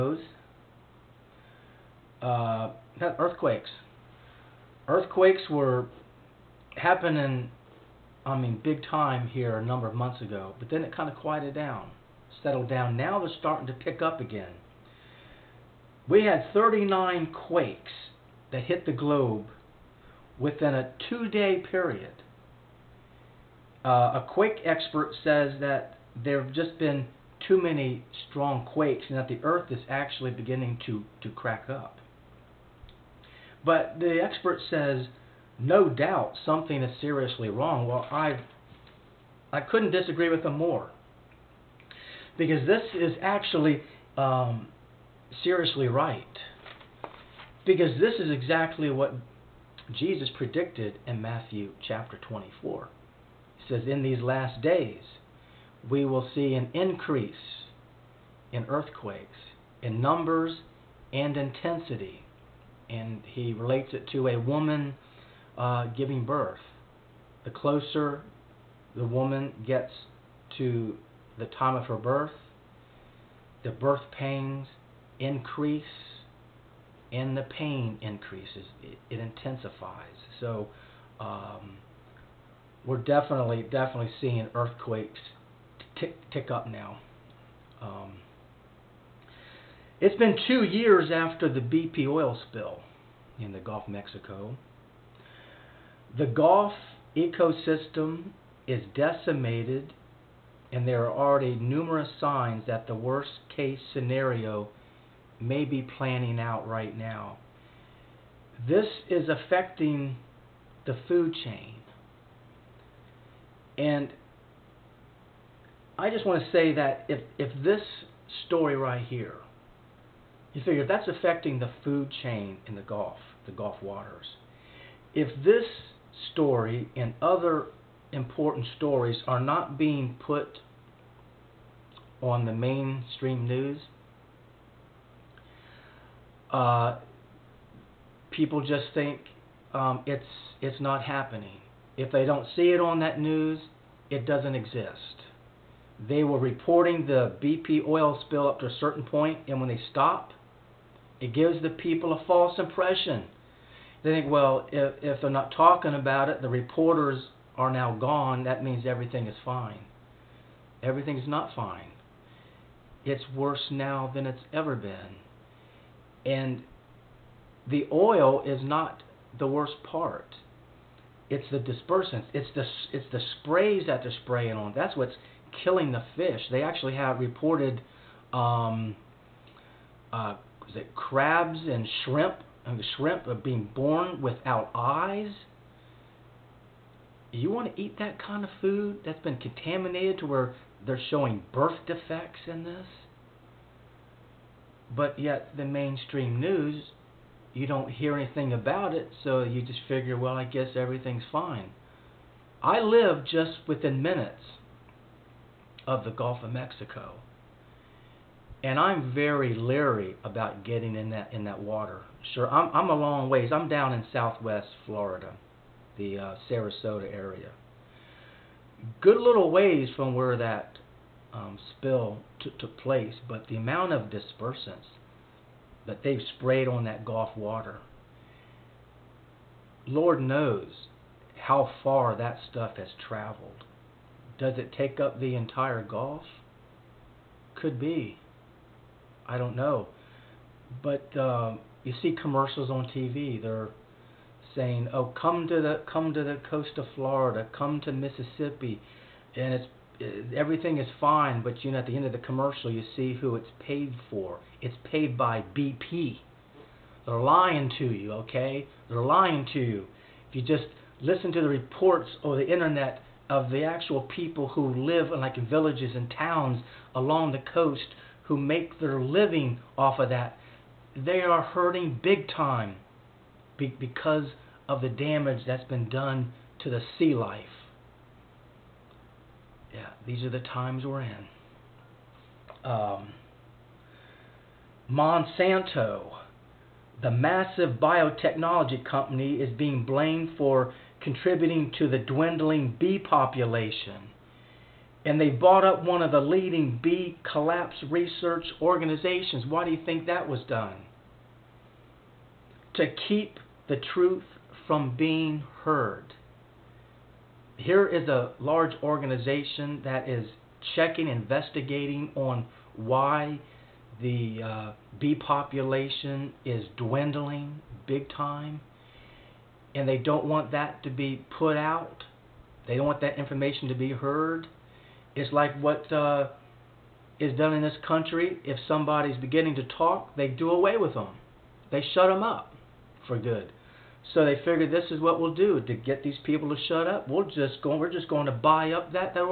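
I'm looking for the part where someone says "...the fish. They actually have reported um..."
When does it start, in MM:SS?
02:55.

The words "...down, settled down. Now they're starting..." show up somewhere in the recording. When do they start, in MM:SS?
00:11.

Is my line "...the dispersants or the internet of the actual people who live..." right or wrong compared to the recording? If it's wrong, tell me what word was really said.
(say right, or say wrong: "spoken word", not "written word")
wrong: "reports", not "dispersants".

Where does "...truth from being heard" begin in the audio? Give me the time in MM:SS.
05:03.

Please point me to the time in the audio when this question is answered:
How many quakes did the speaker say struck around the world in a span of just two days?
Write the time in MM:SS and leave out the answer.
00:16.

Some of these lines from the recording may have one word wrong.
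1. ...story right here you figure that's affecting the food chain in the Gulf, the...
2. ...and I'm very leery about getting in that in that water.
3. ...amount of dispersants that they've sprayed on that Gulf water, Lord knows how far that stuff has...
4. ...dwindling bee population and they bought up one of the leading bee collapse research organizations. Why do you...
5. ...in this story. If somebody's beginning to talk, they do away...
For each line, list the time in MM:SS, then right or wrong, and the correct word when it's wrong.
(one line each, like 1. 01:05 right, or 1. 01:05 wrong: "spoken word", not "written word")
1. 01:58 right
2. 03:28 right
3. 03:43 right
4. 04:51 right
5. 05:27 wrong: "country", not "story".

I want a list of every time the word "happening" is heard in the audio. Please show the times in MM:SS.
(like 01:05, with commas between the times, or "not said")
00:06, 02:21.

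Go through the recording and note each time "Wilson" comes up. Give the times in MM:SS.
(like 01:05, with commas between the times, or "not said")
not said.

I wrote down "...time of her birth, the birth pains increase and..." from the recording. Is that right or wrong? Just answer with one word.
right.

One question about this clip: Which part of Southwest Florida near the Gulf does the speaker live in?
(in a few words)
Sarasota.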